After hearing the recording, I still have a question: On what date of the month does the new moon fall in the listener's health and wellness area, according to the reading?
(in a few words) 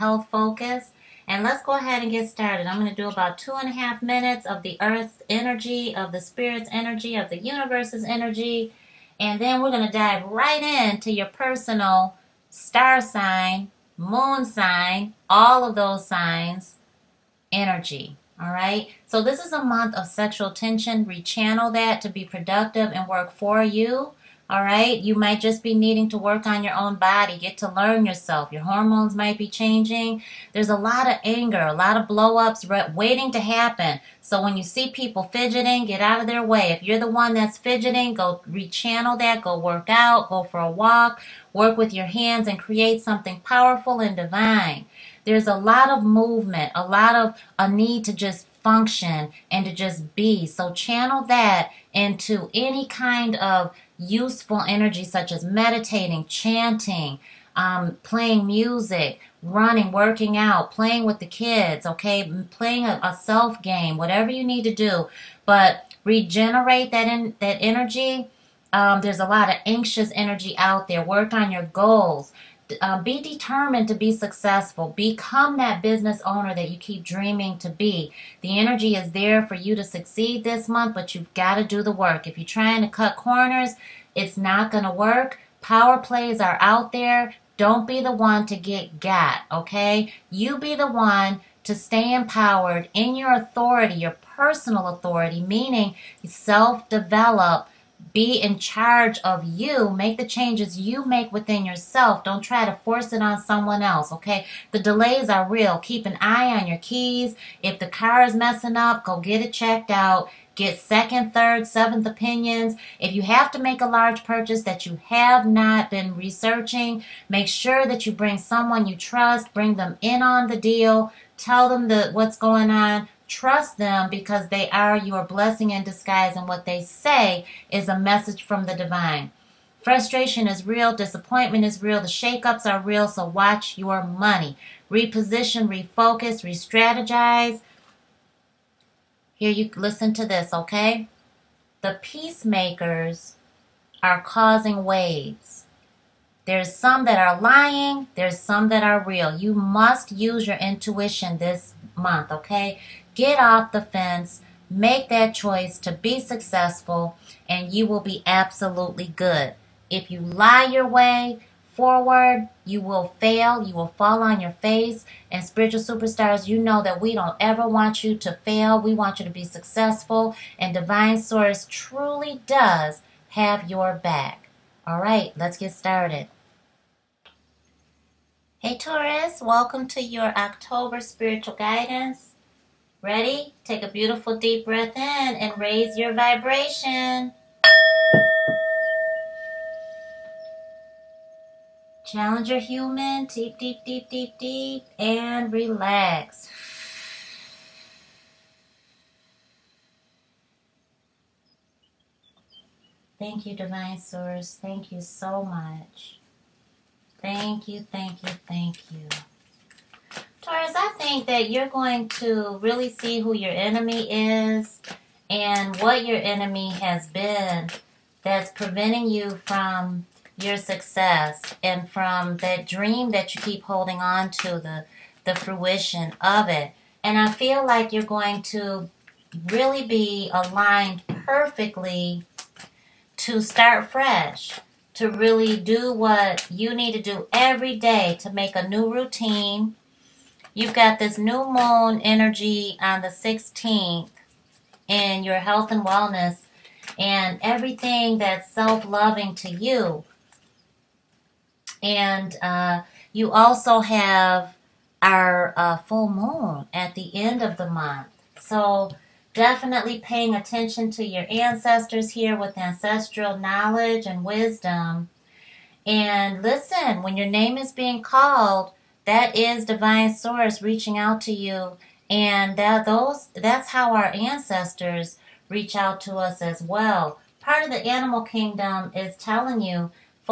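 16th.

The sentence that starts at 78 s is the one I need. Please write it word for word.
The energy is there for you to succeed this month, but you've got to do the work.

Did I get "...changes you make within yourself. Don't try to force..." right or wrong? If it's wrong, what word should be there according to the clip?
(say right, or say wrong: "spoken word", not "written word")
right.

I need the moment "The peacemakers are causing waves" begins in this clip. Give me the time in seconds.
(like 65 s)
141 s.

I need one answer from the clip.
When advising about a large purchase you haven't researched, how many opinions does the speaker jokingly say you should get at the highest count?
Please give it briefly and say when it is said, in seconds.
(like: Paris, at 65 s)
7, at 111 s.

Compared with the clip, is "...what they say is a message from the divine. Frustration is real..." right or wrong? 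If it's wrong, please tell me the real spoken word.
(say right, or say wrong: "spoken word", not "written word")
right.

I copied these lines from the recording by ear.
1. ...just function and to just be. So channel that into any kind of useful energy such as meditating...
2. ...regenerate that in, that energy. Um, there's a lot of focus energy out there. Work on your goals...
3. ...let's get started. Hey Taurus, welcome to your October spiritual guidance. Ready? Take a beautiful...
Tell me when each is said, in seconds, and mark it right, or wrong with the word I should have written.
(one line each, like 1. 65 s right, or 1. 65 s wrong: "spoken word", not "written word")
1. 48 s right
2. 66 s wrong: "anxious", not "focus"
3. 175 s right.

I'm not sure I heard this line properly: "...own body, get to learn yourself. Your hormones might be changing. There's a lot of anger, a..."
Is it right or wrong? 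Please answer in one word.
right.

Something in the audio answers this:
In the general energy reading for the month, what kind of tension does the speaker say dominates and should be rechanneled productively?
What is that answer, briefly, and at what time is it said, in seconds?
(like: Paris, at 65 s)
Sexual tension, at 20 s.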